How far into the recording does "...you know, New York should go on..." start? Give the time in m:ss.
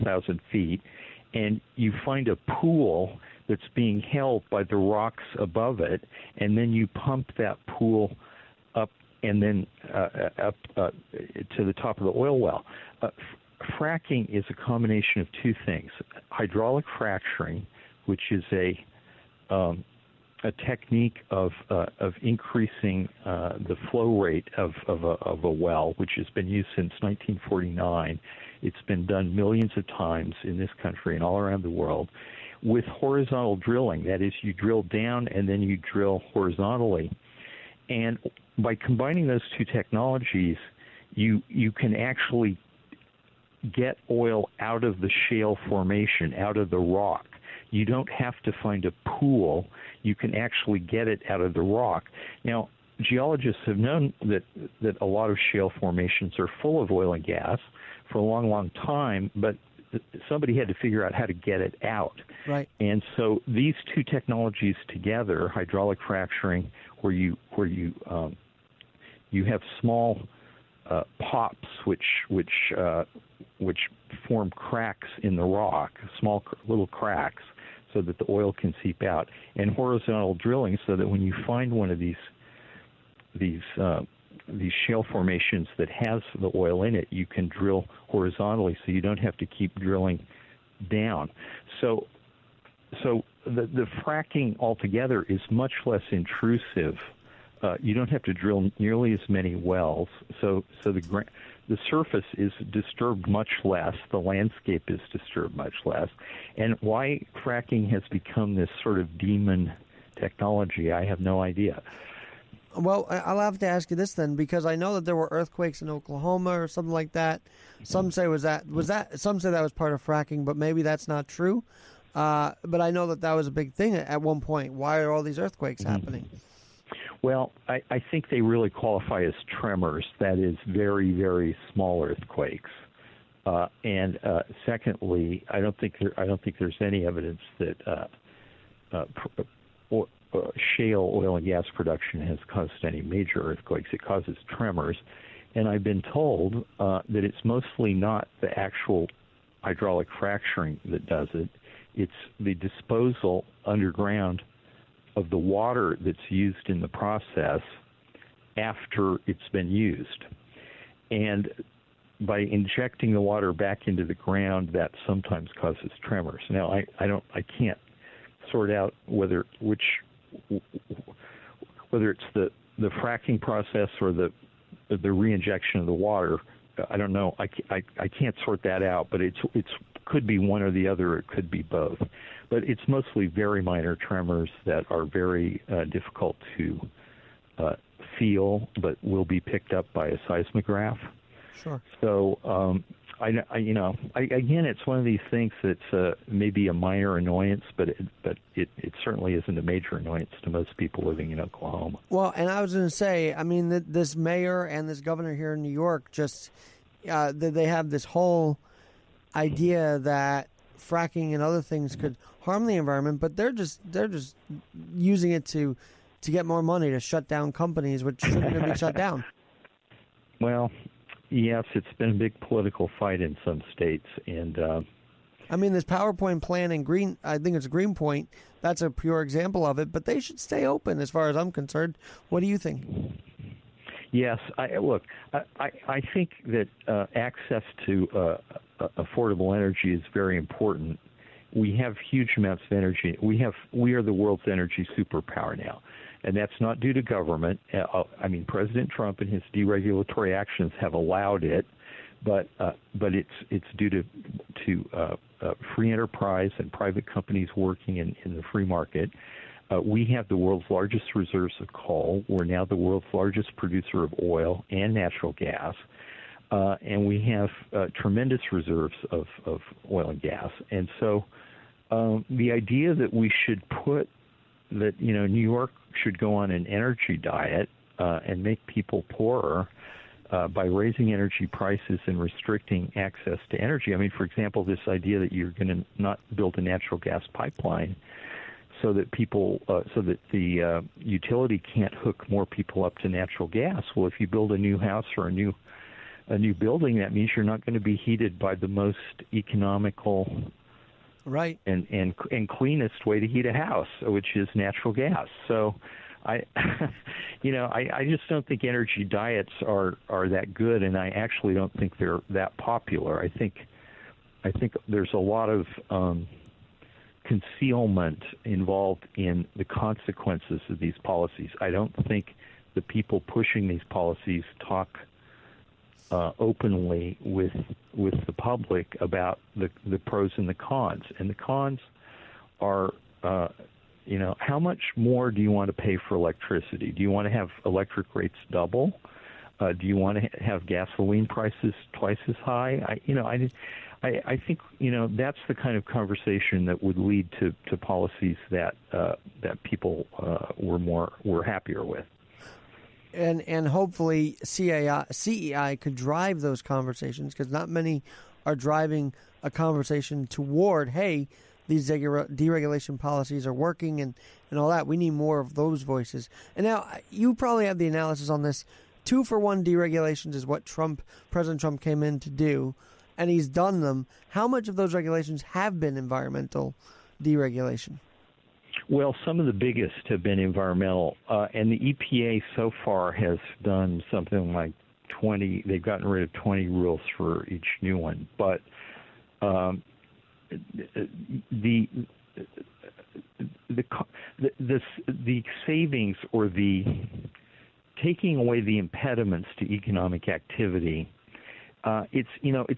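4:34.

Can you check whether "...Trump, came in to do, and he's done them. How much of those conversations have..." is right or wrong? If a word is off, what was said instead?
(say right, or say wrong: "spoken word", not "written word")
wrong: "regulations", not "conversations".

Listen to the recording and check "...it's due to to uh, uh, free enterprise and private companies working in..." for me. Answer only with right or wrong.
right.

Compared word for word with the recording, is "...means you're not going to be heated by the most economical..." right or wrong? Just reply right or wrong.
right.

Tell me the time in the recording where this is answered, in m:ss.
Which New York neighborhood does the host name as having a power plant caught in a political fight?
3:47.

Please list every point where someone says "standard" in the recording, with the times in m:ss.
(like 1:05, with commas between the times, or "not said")
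not said.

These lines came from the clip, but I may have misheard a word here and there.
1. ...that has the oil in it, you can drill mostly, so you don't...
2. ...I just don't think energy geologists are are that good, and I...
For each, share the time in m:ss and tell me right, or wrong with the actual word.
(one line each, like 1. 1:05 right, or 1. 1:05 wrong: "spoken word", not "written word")
1. 1:25 wrong: "horizontally", not "mostly"
2. 5:07 wrong: "diets", not "geologists".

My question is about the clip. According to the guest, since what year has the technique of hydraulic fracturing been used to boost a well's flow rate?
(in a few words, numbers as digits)
1949.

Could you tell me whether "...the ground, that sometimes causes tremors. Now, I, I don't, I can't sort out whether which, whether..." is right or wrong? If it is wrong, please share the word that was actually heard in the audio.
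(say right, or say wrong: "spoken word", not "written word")
right.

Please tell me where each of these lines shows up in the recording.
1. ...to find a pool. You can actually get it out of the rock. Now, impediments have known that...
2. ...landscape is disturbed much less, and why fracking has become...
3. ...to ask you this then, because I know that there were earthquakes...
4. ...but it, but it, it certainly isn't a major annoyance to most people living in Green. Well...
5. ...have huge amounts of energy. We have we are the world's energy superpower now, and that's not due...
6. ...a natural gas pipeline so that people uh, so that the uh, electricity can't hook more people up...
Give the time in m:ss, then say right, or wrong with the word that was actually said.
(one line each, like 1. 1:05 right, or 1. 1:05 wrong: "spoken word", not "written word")
1. 0:48 wrong: "geologists", not "impediments"
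2. 1:44 right
3. 1:53 right
4. 3:17 wrong: "Oklahoma", not "Green"
5. 4:01 right
6. 4:46 wrong: "utility", not "electricity".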